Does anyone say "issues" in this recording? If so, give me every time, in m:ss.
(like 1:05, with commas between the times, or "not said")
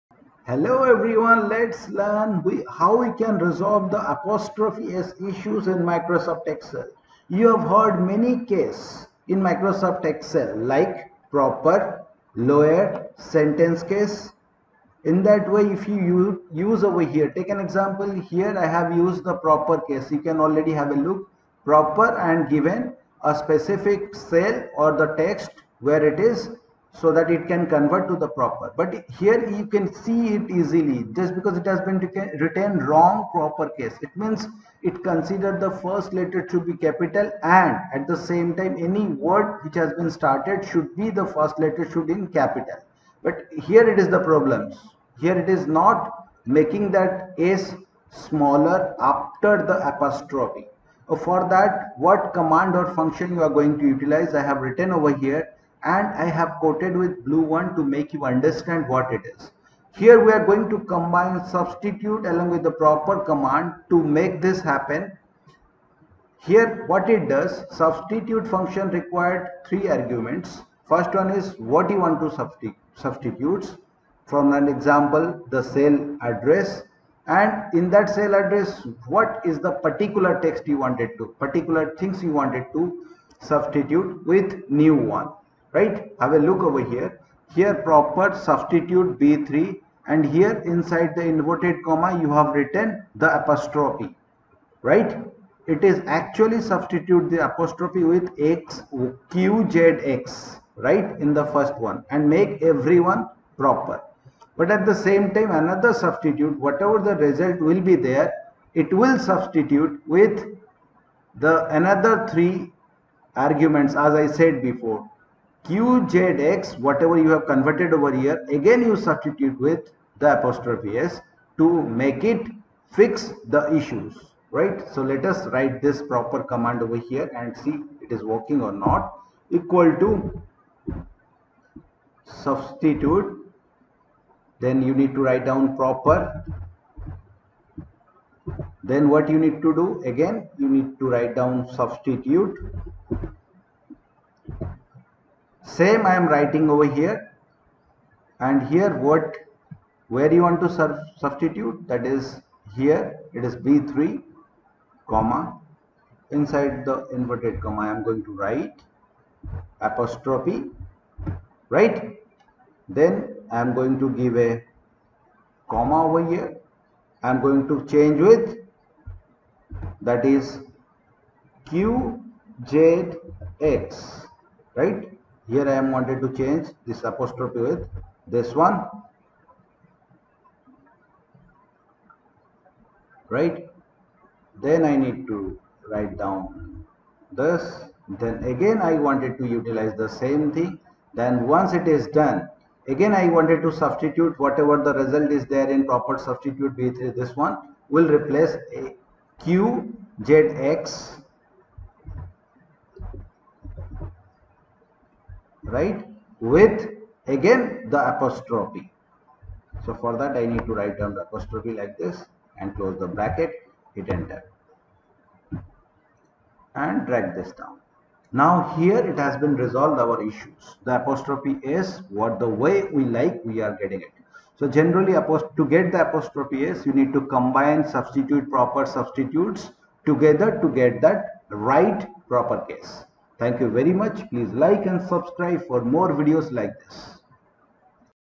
0:05, 2:03, 3:40.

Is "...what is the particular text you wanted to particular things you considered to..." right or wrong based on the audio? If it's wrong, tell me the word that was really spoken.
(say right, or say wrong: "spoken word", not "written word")
wrong: "wanted", not "considered".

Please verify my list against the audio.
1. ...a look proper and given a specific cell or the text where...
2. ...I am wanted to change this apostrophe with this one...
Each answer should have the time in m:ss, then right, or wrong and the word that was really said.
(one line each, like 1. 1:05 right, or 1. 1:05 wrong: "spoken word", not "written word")
1. 0:20 right
2. 2:55 right.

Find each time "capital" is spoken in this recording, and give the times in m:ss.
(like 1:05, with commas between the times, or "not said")
0:36, 0:42.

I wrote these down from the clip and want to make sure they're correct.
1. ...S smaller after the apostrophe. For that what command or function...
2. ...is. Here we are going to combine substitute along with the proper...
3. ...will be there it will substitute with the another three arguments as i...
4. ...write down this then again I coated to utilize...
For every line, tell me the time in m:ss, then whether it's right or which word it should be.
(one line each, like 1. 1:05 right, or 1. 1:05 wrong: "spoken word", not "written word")
1. 0:47 right
2. 0:59 right
3. 1:47 right
4. 3:05 wrong: "wanted", not "coated".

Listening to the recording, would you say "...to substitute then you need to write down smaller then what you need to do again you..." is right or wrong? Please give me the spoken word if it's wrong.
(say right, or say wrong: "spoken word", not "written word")
wrong: "proper", not "smaller".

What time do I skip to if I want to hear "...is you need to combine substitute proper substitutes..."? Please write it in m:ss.
3:46.